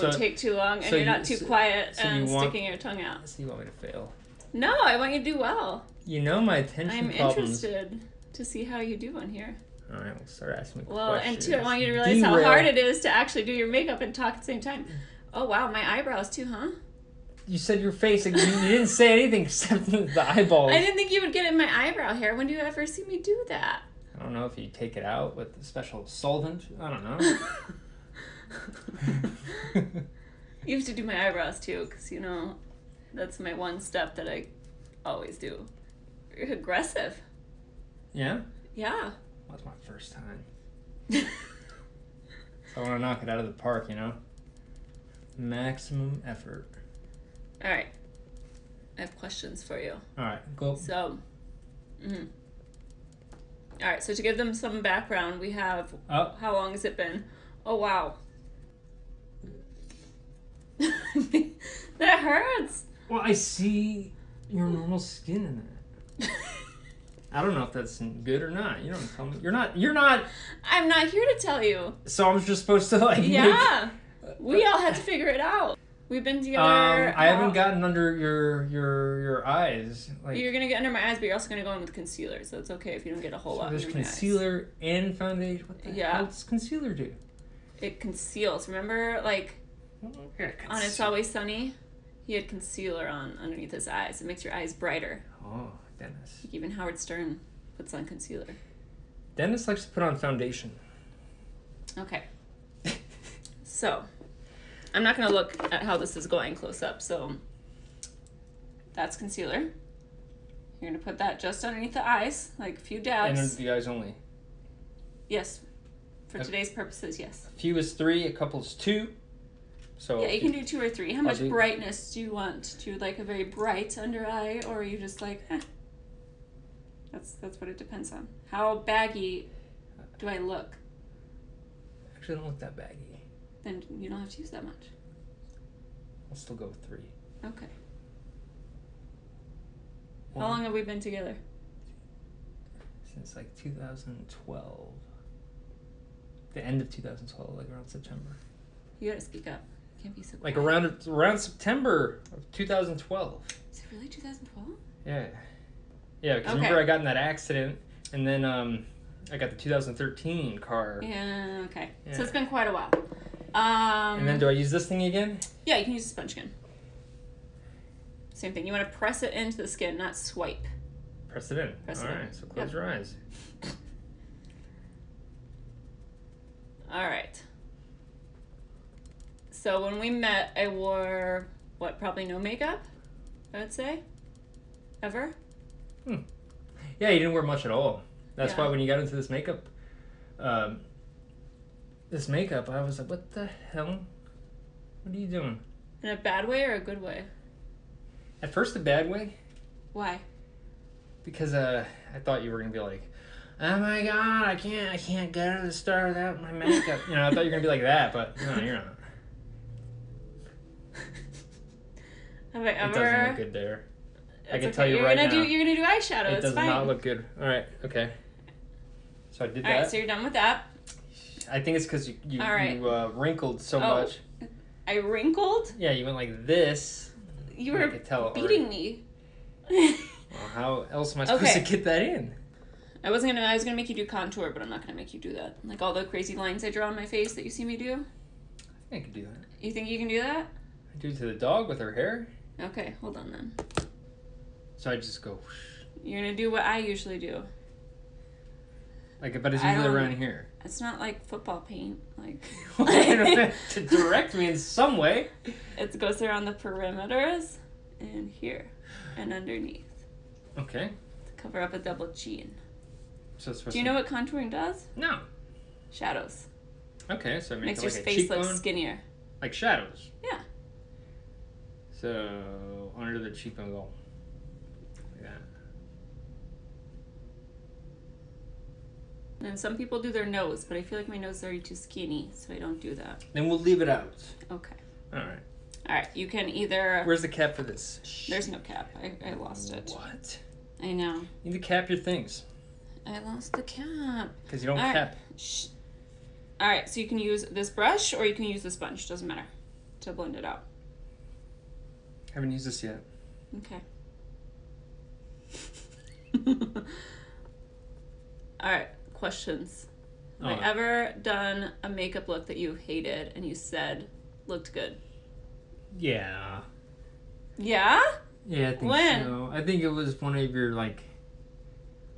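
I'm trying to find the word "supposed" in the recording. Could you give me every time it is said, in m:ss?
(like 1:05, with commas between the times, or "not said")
1:12, 3:51.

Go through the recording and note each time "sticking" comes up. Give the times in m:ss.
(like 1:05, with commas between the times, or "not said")
0:02.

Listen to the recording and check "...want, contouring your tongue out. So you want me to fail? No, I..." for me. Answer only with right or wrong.
wrong.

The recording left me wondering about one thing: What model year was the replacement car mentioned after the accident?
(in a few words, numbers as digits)
2013.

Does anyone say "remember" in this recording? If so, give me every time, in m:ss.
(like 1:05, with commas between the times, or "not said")
1:28, 2:36.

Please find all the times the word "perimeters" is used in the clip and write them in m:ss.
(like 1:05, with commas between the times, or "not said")
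4:16.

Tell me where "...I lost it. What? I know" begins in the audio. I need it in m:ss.
4:49.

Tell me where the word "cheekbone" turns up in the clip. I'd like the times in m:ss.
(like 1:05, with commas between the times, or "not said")
4:28, 4:33.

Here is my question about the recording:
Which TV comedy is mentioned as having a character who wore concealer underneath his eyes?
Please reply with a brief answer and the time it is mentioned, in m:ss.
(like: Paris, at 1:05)
It's Always Sunny, at 1:30.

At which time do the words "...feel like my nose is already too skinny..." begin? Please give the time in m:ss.
4:40.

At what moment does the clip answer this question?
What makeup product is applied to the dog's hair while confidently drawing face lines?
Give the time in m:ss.
3:54.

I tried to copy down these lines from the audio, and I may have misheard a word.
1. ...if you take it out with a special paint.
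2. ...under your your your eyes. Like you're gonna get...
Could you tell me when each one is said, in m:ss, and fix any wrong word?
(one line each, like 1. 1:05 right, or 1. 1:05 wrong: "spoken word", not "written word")
1. 0:24 wrong: "solvent", not "paint"
2. 1:17 right.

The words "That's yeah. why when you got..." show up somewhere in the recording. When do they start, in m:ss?
3:08.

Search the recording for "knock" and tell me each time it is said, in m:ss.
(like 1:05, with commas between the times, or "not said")
0:42.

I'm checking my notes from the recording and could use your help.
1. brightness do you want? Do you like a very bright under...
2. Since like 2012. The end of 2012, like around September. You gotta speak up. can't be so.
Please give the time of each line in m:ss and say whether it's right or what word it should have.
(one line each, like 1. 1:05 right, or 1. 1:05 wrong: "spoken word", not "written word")
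1. 2:01 right
2. 2:23 right.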